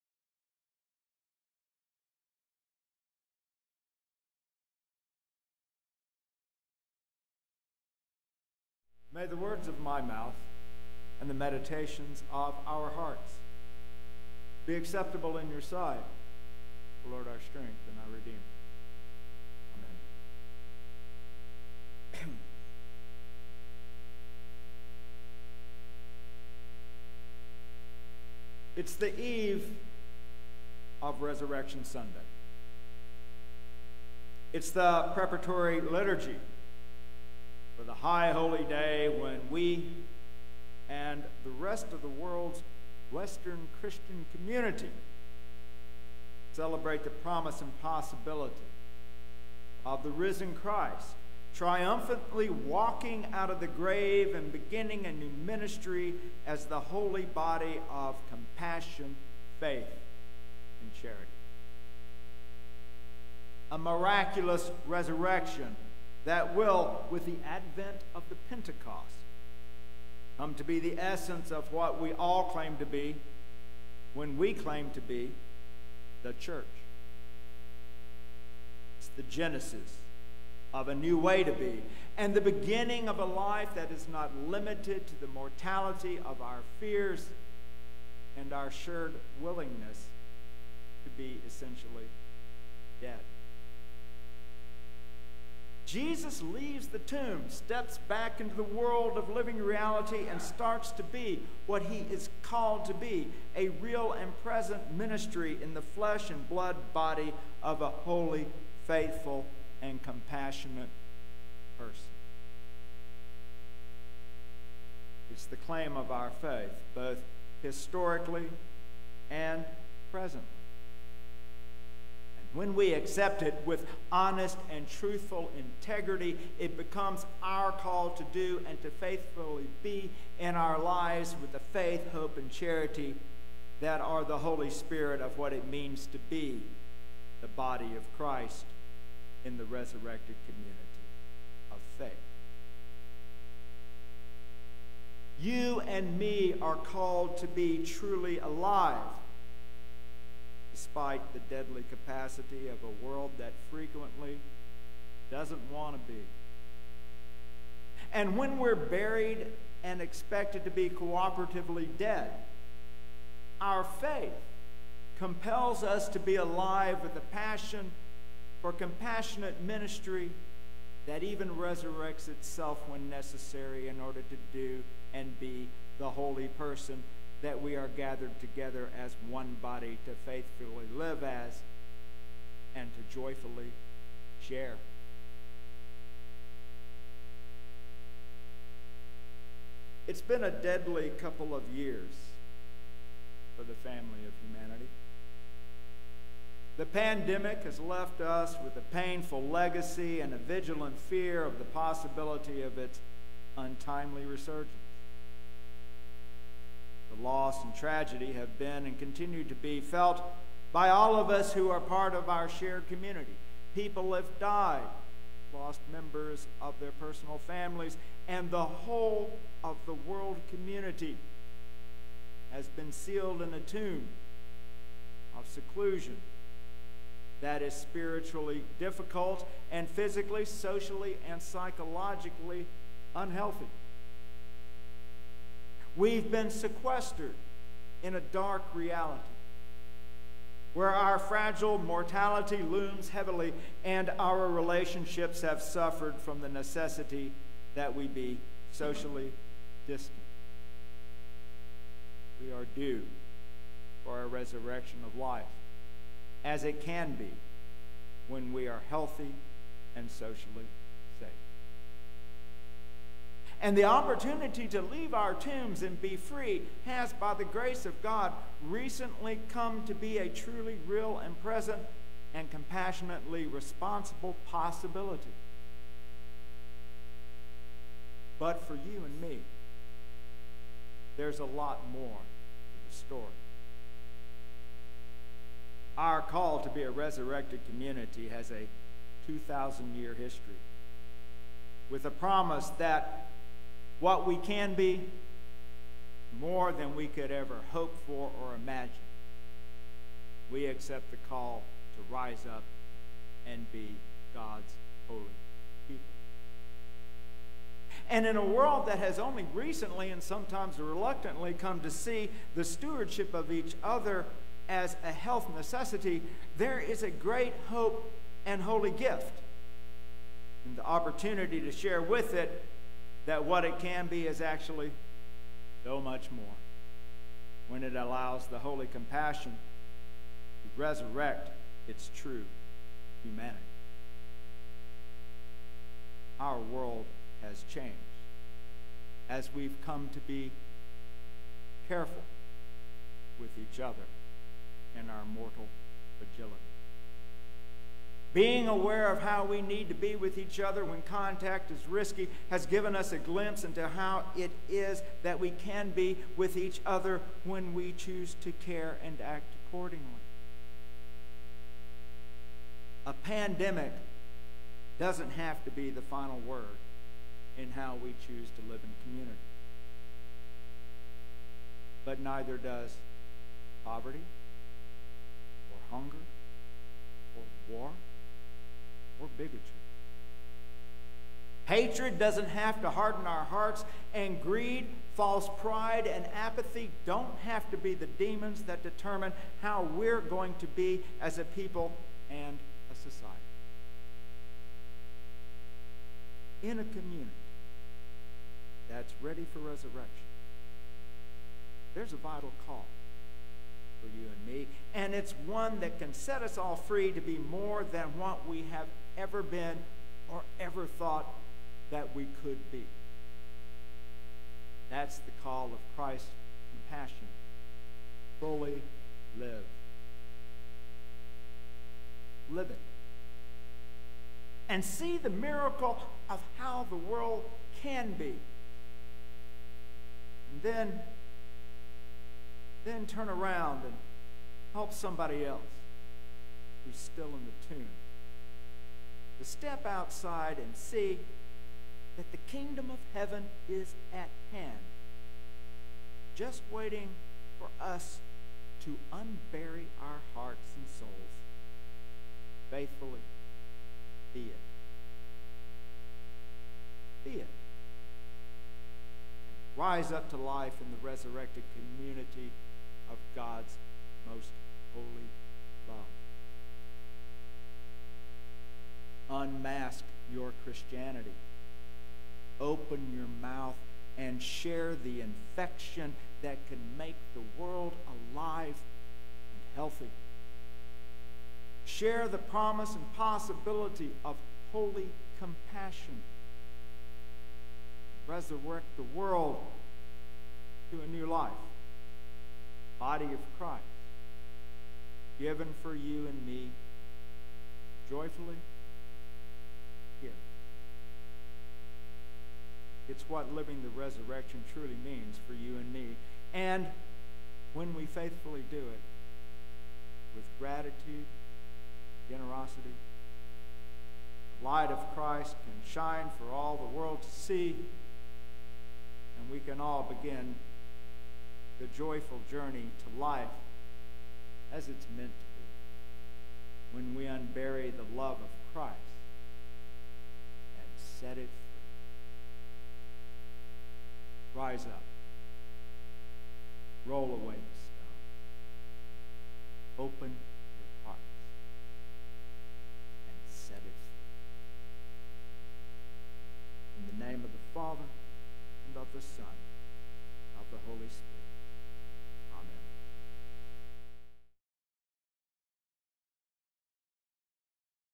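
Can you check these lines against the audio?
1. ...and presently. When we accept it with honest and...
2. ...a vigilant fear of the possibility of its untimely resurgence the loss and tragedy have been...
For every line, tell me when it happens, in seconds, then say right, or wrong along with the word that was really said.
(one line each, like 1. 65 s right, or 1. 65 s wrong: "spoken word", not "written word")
1. 119 s right
2. 200 s right.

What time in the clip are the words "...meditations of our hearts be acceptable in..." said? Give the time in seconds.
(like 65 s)
11 s.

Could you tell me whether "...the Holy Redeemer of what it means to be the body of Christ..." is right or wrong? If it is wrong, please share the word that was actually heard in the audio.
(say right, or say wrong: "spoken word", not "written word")
wrong: "Spirit", not "Redeemer".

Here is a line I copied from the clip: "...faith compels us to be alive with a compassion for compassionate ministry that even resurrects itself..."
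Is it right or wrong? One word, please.
wrong.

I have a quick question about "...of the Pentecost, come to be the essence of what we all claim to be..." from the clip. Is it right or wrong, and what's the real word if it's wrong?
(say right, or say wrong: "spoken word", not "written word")
right.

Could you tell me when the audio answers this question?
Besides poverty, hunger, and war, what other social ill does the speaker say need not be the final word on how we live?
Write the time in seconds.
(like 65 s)
379 s.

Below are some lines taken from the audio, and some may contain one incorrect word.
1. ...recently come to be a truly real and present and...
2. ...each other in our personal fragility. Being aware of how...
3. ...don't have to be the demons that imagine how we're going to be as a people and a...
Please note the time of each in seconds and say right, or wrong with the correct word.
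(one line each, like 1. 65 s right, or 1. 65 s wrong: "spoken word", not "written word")
1. 268 s right
2. 343 s wrong: "mortal", not "personal"
3. 387 s wrong: "determine", not "imagine".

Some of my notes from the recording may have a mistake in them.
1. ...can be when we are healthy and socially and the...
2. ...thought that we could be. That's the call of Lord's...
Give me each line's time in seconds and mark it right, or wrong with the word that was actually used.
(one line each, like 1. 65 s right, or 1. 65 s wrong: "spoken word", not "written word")
1. 256 s right
2. 410 s wrong: "Christ", not "Lord".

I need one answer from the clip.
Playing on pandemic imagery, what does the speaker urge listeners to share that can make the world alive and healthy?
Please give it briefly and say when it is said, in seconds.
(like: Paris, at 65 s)
the infection, at 474 s.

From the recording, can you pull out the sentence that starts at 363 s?
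A pandemic doesn't have to be the final word in how we choose to live in community.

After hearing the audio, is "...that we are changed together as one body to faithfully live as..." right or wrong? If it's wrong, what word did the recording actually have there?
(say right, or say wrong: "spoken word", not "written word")
wrong: "gathered", not "changed".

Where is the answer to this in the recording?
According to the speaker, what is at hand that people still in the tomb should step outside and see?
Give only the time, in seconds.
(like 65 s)
442 s.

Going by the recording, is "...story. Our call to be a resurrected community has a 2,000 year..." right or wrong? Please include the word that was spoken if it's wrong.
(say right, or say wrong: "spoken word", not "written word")
right.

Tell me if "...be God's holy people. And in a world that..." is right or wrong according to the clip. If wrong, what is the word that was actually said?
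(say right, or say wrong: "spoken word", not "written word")
right.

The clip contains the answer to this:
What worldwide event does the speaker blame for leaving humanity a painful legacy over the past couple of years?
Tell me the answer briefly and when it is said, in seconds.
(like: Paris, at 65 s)
The pandemic, at 196 s.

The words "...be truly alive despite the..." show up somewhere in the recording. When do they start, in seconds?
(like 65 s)
147 s.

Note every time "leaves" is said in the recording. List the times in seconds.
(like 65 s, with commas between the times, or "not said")
96 s, 264 s.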